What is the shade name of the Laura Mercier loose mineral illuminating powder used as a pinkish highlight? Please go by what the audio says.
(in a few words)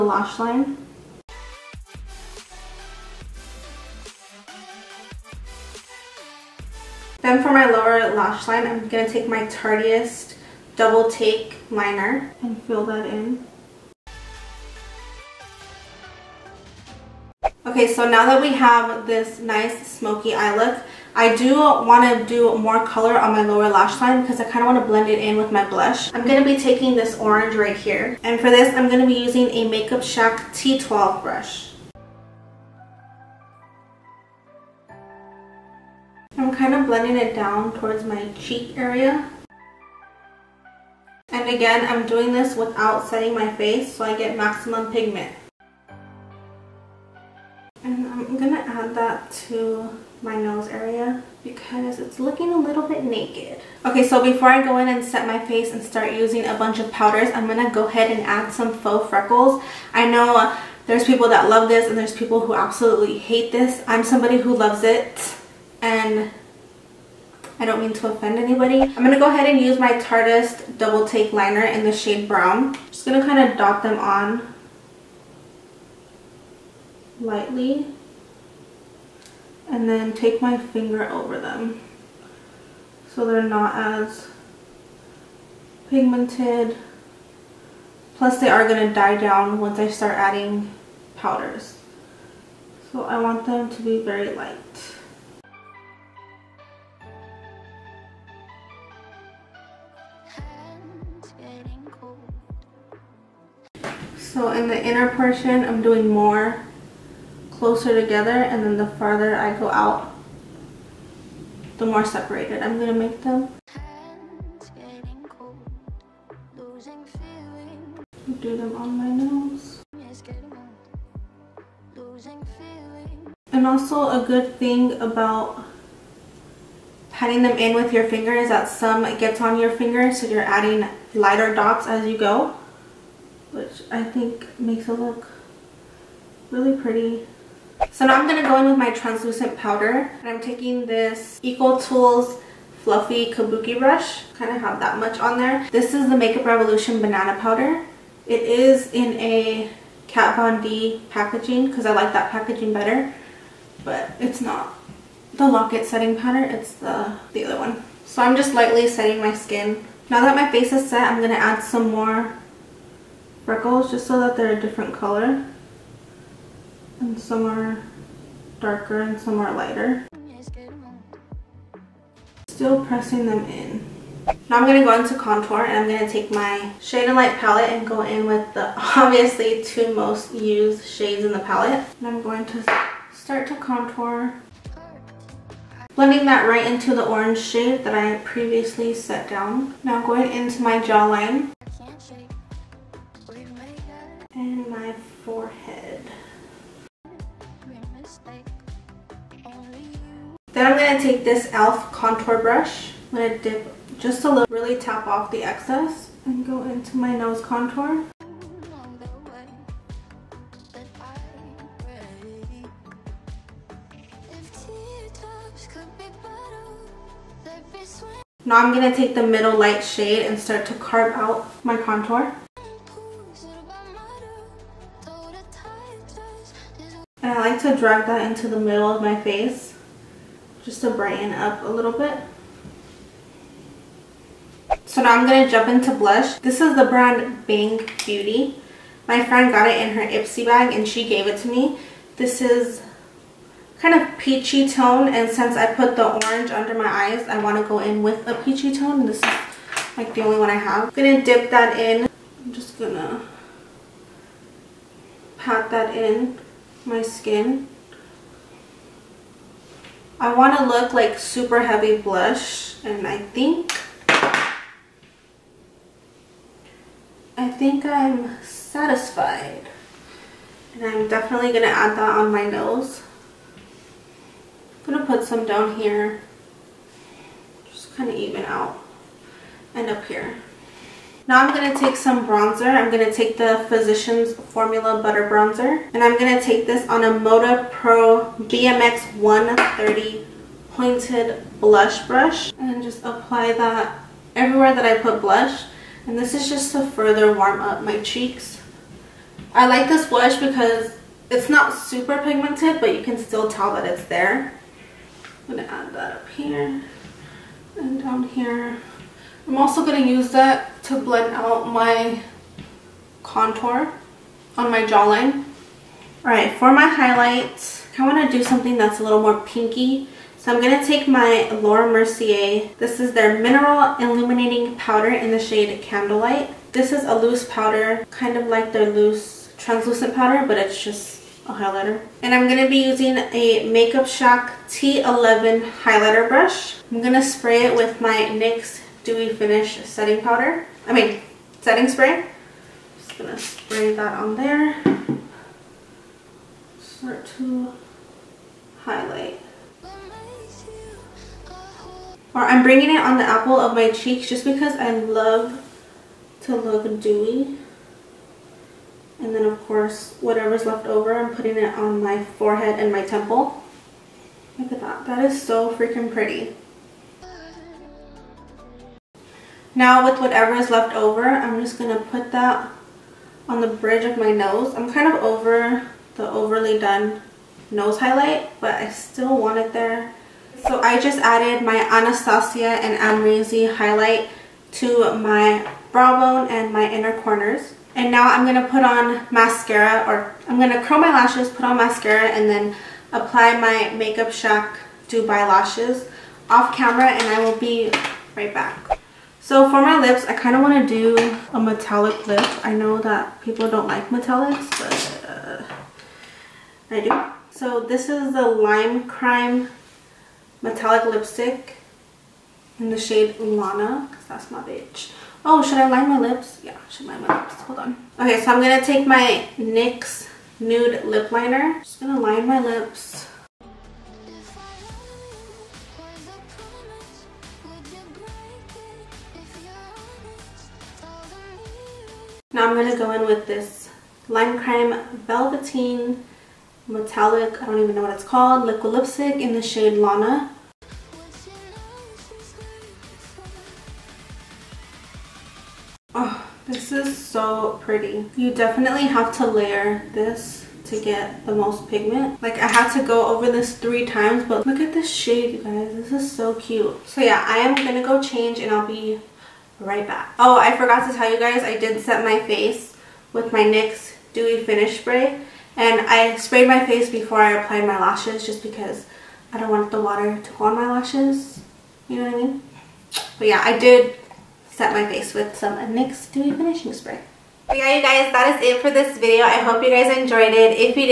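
Candlelight.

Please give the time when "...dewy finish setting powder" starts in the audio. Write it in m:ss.
5:39.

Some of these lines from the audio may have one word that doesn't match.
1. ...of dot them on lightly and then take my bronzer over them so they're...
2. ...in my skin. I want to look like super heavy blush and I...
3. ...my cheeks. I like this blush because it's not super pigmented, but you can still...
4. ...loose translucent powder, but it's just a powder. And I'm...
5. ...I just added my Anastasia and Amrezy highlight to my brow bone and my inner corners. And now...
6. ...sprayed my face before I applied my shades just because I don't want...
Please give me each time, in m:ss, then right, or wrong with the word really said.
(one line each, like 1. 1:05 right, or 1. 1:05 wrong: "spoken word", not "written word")
1. 1:13 wrong: "finger", not "bronzer"
2. 4:15 right
3. 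4:57 right
4. 5:28 wrong: "highlighter", not "powder"
5. 6:20 right
6. 7:46 wrong: "lashes", not "shades".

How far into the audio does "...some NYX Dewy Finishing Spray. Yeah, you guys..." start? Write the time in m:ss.
7:55.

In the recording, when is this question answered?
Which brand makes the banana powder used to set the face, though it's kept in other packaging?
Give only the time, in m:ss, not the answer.
2:26.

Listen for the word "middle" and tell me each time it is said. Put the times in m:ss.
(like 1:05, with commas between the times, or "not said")
3:39, 3:48.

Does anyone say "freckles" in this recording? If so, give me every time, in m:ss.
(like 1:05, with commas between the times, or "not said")
0:59, 2:43.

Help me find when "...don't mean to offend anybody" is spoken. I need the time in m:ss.
1:07.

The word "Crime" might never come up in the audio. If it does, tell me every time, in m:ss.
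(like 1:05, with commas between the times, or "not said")
6:49, 7:14.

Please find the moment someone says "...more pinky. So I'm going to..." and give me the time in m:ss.
5:19.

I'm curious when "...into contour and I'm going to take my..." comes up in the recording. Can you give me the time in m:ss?
2:54.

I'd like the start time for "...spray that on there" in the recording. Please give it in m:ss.
5:43.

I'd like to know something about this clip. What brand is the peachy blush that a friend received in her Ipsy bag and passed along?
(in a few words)
Bang Beauty.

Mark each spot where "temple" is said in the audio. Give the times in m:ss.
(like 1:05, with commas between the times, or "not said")
6:03.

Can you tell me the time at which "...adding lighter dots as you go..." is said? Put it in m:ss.
2:10.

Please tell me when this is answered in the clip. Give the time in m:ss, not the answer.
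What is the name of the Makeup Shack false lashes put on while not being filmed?
6:35.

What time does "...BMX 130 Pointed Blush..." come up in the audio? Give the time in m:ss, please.
4:48.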